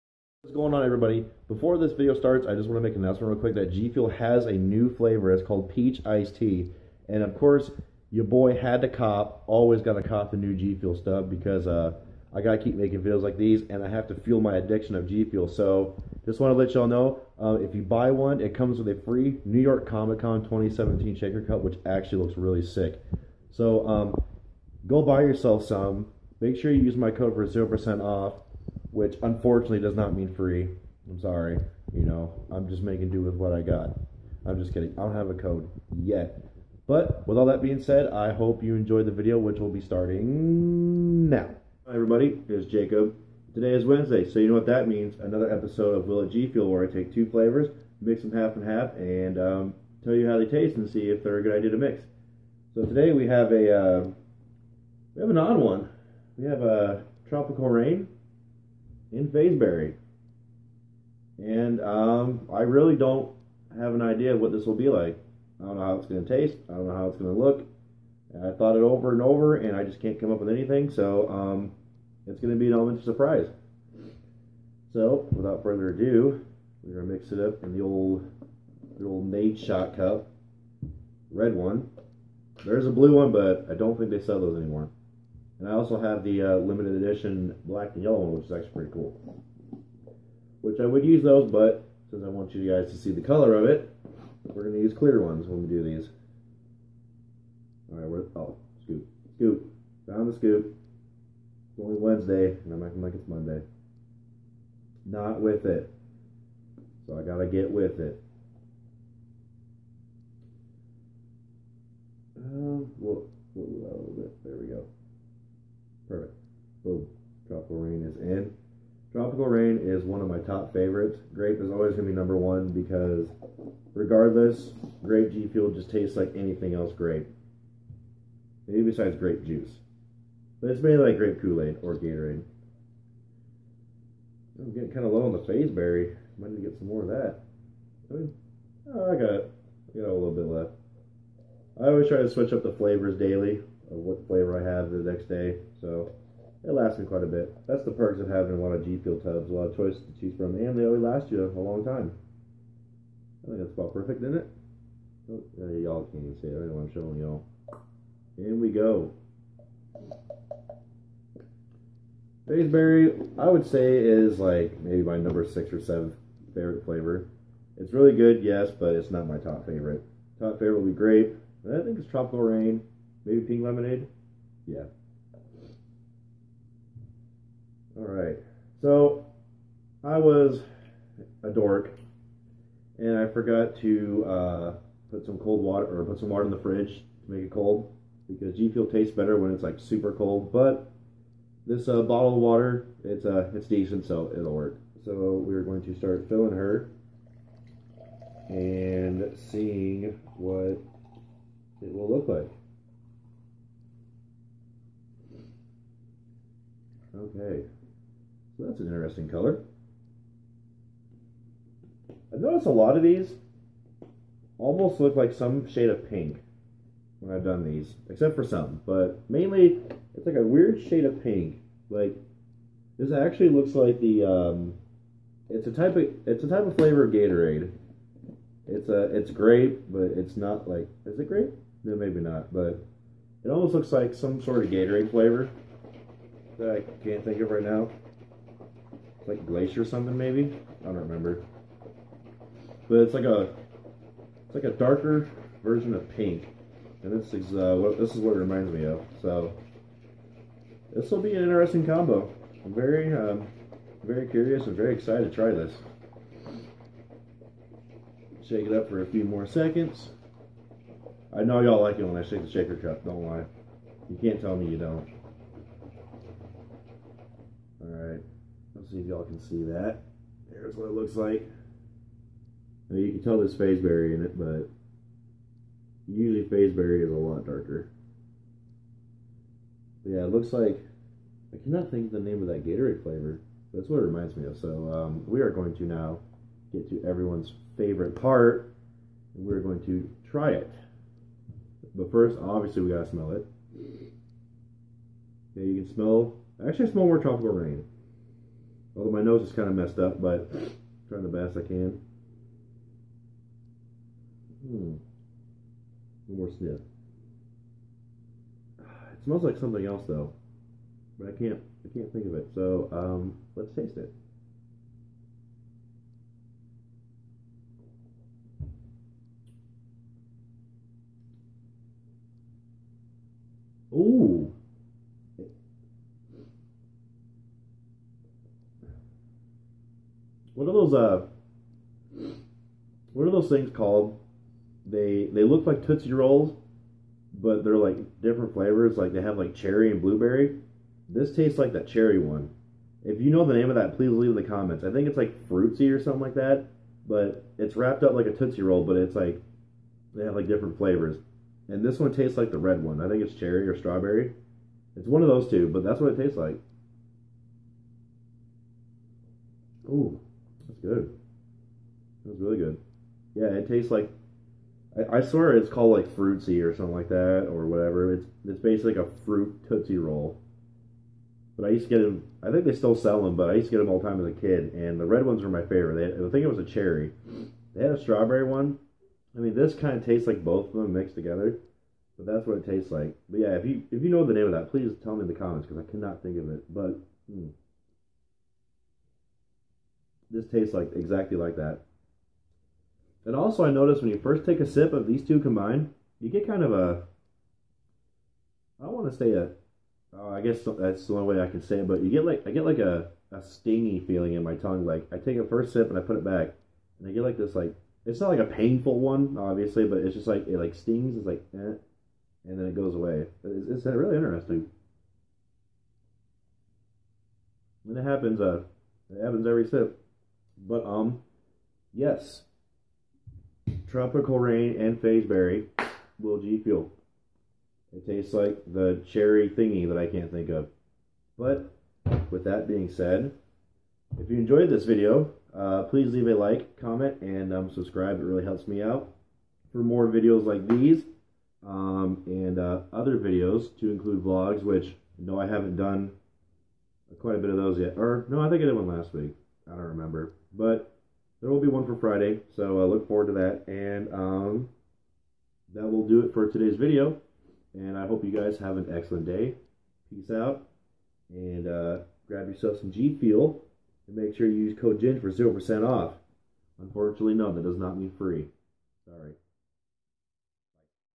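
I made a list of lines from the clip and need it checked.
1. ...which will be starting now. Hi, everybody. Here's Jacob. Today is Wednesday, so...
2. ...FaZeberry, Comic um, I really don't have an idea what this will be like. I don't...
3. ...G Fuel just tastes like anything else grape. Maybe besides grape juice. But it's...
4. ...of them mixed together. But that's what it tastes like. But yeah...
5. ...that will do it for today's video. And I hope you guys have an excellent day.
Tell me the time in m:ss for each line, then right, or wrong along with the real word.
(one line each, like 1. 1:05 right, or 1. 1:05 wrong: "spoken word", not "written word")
1. 0:39 right
2. 0:59 wrong: "And", not "Comic"
3. 2:05 right
4. 6:20 right
5. 7:35 right.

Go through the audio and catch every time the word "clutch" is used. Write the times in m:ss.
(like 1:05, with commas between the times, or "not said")
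not said.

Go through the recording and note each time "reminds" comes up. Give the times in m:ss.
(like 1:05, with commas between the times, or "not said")
4:08, 4:44.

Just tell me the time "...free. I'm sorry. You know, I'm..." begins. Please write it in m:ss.
0:30.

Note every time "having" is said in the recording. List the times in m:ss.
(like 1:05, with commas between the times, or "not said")
2:28.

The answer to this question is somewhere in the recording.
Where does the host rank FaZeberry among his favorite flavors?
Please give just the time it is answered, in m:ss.
2:45.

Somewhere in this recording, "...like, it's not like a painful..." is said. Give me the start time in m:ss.
6:47.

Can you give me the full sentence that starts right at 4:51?
But first, obviously, we gotta smell it.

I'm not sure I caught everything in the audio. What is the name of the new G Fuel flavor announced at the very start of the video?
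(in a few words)
Peach Iced Tea.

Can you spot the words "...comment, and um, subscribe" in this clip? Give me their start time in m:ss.
7:16.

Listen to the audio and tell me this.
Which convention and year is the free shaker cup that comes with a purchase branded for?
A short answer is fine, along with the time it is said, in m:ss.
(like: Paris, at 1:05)
New York Comic Con 2017, at 0:19.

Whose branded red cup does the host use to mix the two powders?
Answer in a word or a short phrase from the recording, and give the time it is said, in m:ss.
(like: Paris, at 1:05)
Nadeshot, at 1:19.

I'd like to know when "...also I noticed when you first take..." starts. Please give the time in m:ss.
6:33.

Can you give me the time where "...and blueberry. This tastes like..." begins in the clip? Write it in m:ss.
5:39.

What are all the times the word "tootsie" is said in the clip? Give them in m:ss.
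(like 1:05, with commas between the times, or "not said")
5:35, 5:48, 6:09.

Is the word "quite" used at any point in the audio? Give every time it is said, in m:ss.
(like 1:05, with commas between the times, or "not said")
2:27, 7:27.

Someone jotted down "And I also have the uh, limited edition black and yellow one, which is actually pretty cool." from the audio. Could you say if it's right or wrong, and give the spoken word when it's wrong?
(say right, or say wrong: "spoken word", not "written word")
right.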